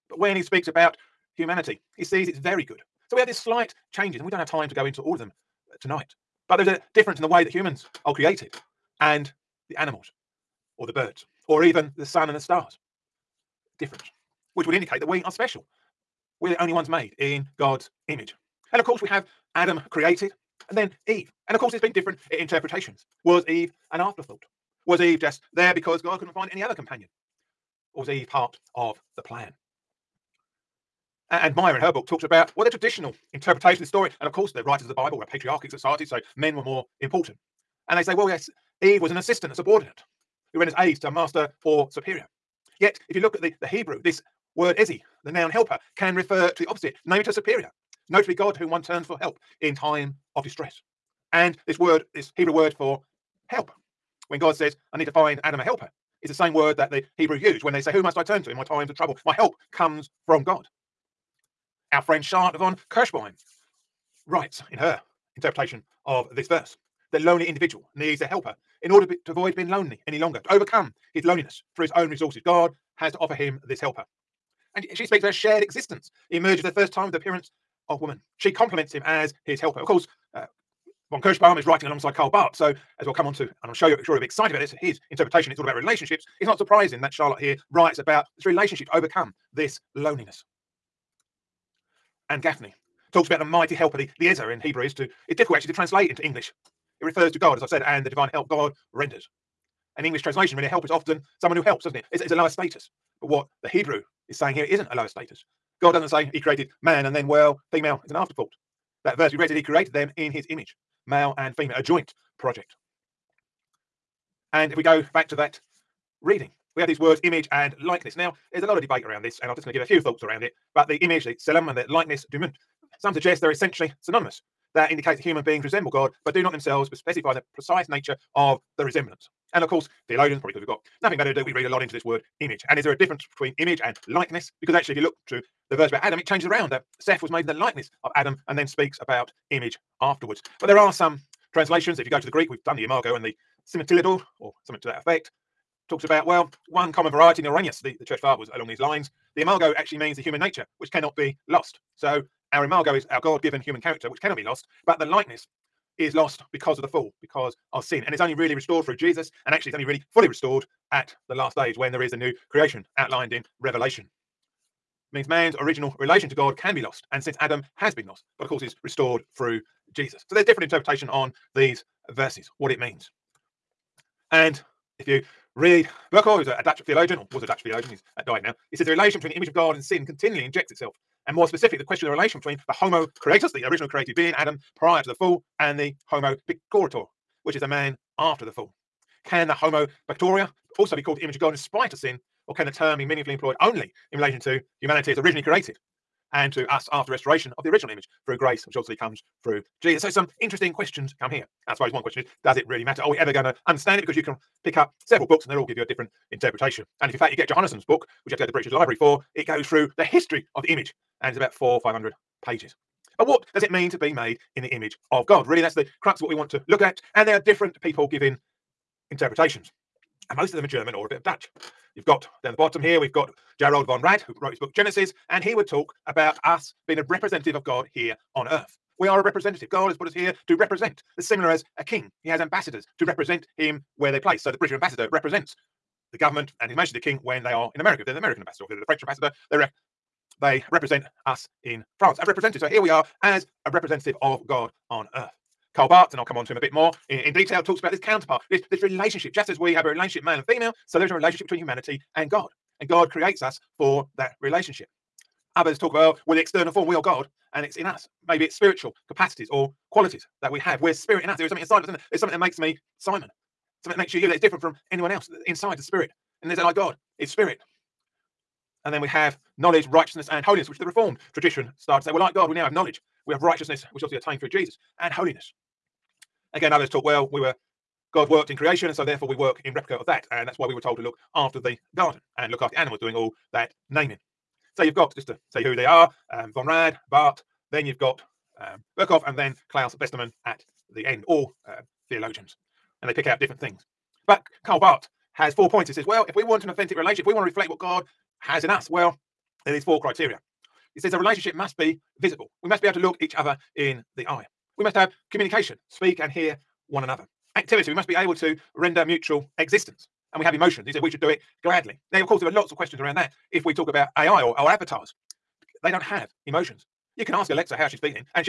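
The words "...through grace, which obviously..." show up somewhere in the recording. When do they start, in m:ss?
3:18.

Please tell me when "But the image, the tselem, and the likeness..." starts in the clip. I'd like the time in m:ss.
2:00.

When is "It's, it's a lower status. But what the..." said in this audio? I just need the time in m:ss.
1:42.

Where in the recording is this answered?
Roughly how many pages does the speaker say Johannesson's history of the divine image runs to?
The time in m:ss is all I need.
3:31.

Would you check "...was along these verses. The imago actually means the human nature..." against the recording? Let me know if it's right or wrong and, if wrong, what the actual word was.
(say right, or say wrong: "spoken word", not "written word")
wrong: "lines", not "verses".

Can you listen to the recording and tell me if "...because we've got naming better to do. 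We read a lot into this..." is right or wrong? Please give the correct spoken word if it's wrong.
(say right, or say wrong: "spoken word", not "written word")
wrong: "nothing", not "naming".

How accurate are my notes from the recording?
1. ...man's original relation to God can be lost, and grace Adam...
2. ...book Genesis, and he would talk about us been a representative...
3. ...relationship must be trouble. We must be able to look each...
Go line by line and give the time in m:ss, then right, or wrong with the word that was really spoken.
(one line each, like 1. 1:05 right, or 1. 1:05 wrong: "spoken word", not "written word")
1. 2:45 wrong: "since", not "grace"
2. 3:44 right
3. 5:01 wrong: "visible", not "trouble".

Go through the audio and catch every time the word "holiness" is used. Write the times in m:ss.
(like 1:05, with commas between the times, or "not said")
4:30, 4:35.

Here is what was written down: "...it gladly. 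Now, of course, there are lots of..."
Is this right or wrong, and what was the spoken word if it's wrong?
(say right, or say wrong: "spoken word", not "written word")
right.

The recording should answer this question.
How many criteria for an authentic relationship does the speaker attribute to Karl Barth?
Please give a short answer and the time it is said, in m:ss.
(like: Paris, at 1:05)
4, at 4:55.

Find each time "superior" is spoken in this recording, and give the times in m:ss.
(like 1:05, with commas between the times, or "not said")
0:41, 0:47.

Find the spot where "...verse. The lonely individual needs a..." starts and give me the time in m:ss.
1:06.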